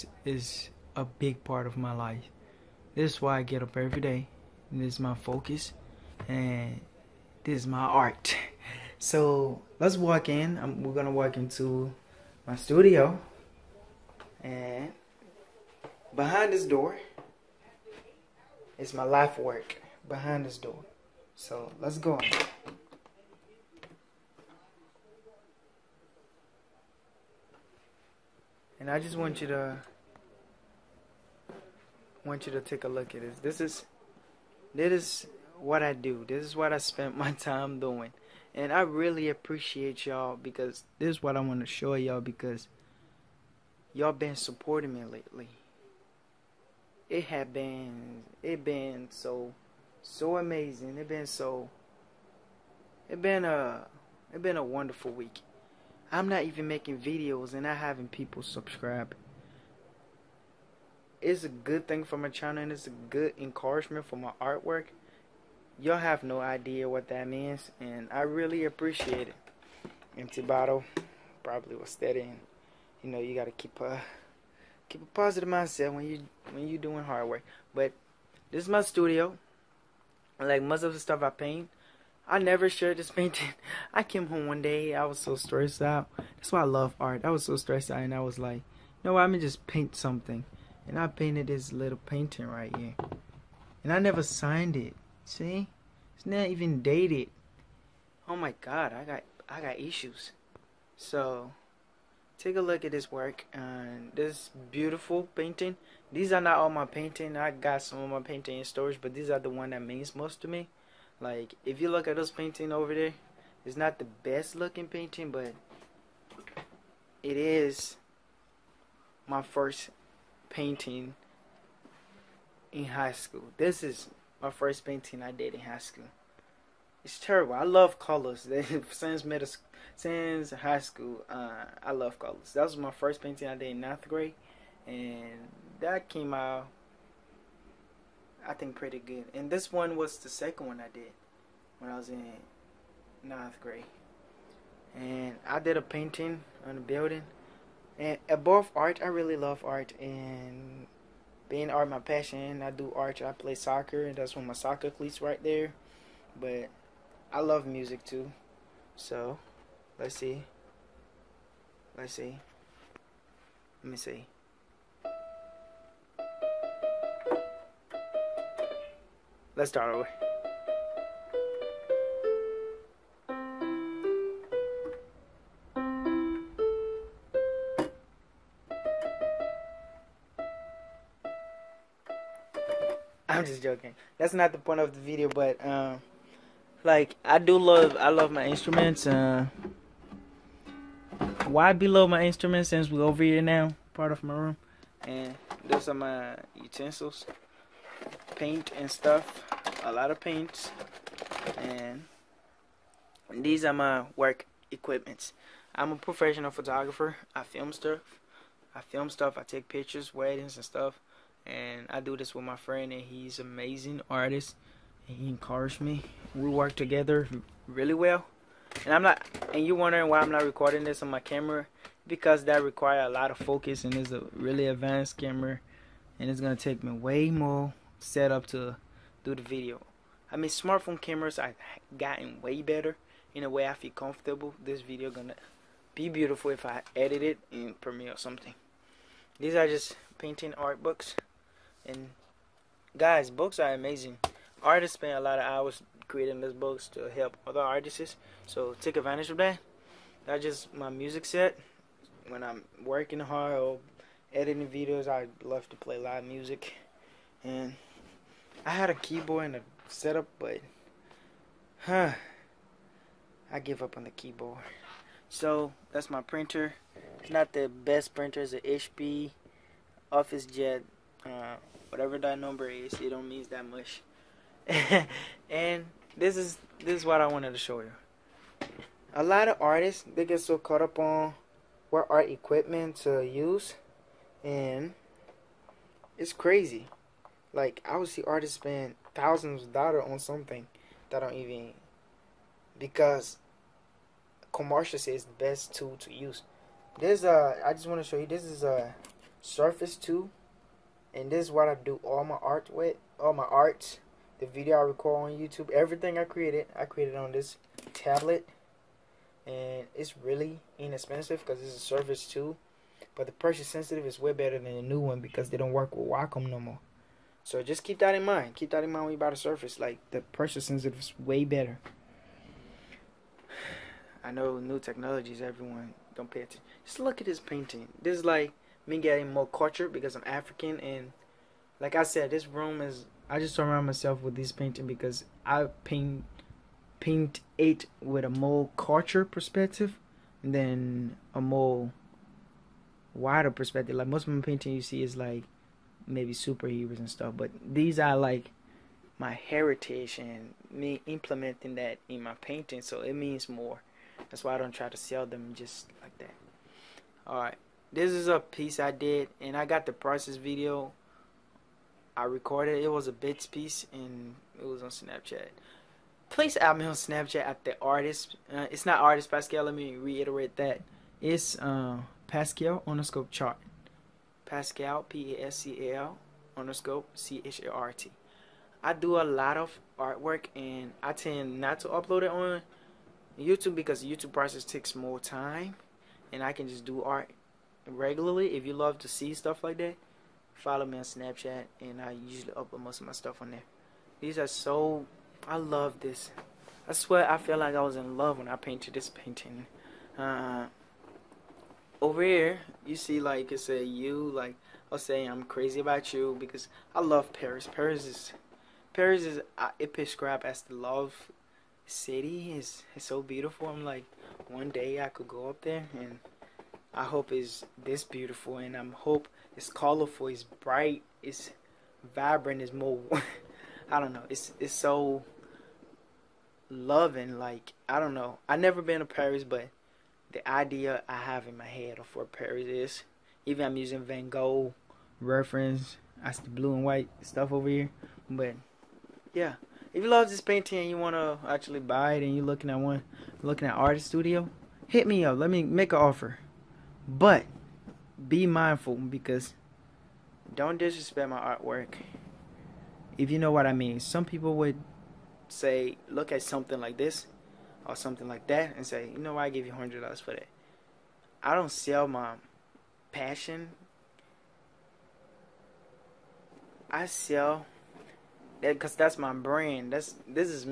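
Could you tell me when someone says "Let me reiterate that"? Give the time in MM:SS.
06:09.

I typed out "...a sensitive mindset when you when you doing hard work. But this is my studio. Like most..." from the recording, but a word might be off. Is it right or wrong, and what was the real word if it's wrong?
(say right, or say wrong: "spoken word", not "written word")
wrong: "positive", not "sensitive".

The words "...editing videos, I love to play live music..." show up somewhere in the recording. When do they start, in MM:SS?
04:14.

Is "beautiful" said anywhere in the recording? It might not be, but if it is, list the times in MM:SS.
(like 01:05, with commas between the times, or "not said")
01:44, 03:56, 06:53, 06:58.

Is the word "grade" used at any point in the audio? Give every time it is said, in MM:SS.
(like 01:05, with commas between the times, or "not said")
02:14, 02:23.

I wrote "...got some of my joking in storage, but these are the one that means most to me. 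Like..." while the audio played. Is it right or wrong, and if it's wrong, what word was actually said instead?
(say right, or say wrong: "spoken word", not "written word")
wrong: "painting", not "joking".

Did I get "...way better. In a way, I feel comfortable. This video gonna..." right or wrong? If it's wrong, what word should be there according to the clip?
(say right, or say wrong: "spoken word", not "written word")
right.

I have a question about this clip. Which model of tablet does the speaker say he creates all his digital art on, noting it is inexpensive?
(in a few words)
Surface 2.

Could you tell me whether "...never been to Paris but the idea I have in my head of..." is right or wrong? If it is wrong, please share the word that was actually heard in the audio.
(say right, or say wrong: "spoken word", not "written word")
right.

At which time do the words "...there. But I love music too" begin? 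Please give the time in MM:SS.
02:35.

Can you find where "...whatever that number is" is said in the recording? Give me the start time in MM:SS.
04:31.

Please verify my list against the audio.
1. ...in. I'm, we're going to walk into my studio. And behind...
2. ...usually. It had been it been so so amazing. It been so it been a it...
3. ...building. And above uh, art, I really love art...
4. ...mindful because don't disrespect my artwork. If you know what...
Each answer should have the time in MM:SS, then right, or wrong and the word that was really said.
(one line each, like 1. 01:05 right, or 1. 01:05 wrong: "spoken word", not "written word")
1. 00:10 right
2. 00:45 wrong: "lately", not "usually"
3. 02:26 right
4. 07:28 right.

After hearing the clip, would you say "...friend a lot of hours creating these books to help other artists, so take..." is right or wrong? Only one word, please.
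wrong.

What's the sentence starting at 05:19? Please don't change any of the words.
Like the pressure sensitive is way better.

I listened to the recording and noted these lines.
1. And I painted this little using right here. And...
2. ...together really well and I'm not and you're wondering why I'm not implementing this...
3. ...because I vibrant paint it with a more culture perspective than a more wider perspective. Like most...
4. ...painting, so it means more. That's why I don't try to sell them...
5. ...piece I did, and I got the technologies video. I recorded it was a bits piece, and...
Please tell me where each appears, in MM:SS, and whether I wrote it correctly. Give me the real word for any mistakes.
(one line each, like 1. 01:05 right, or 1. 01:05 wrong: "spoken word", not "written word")
1. 01:30 wrong: "painting", not "using"
2. 03:36 wrong: "recording", not "implementing"
3. 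05:34 wrong: "paint", not "vibrant"
4. 05:52 right
5. 05:58 wrong: "prices", not "technologies".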